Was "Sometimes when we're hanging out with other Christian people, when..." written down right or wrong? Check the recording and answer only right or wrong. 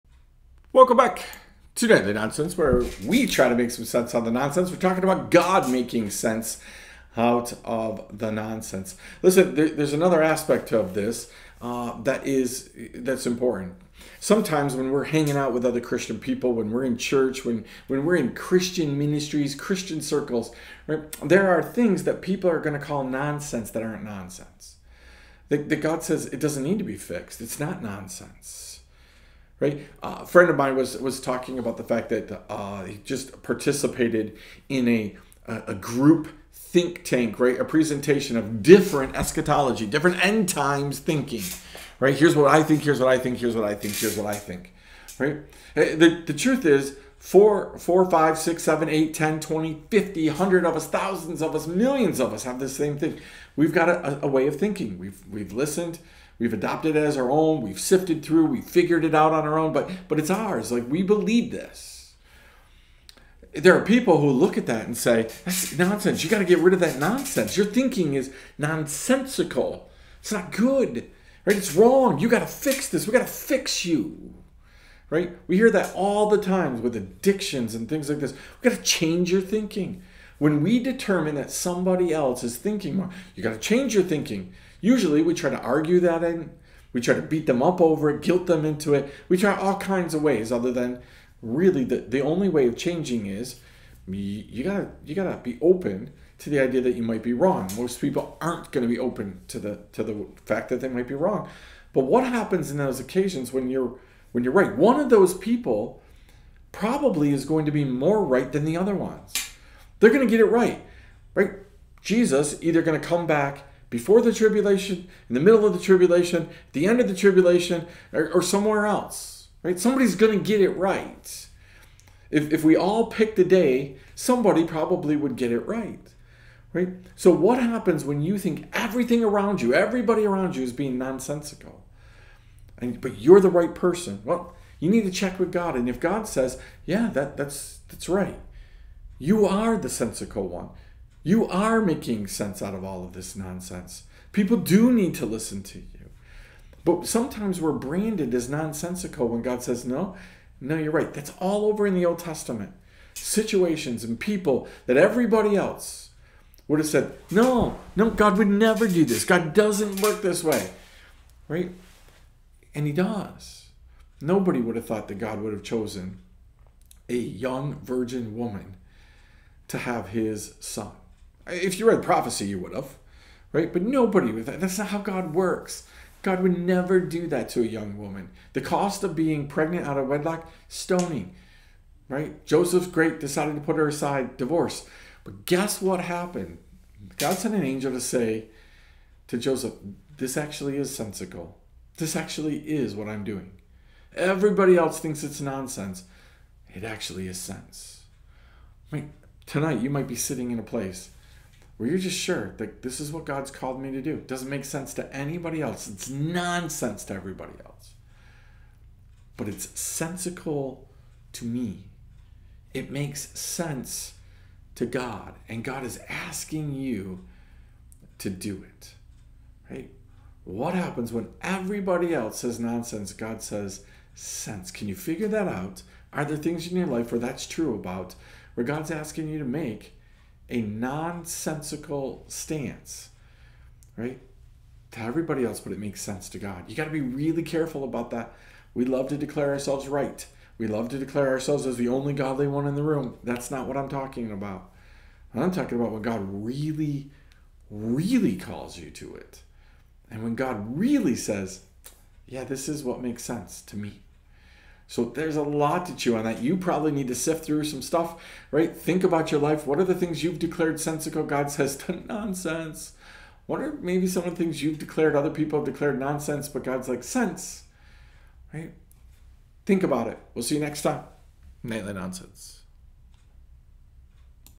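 right.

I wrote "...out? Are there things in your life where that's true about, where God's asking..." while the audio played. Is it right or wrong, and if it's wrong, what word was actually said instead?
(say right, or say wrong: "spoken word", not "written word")
right.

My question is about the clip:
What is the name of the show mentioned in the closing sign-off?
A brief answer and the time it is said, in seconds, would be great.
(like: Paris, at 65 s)
Nightly Nonsense, at 271 s.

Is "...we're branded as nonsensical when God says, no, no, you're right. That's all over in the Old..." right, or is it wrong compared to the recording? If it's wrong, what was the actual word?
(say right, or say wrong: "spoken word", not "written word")
right.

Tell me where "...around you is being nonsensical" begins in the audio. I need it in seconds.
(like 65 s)
130 s.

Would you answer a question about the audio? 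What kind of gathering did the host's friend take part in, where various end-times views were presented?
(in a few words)
Group think tank.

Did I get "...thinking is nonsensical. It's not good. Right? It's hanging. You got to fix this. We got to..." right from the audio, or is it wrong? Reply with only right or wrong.
wrong.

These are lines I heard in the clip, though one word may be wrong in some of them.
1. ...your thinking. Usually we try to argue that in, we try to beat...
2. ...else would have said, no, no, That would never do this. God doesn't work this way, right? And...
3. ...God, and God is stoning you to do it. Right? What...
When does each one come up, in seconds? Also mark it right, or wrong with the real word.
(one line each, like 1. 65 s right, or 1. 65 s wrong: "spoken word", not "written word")
1. 83 s right
2. 155 s wrong: "God", not "That"
3. 214 s wrong: "asking", not "stoning".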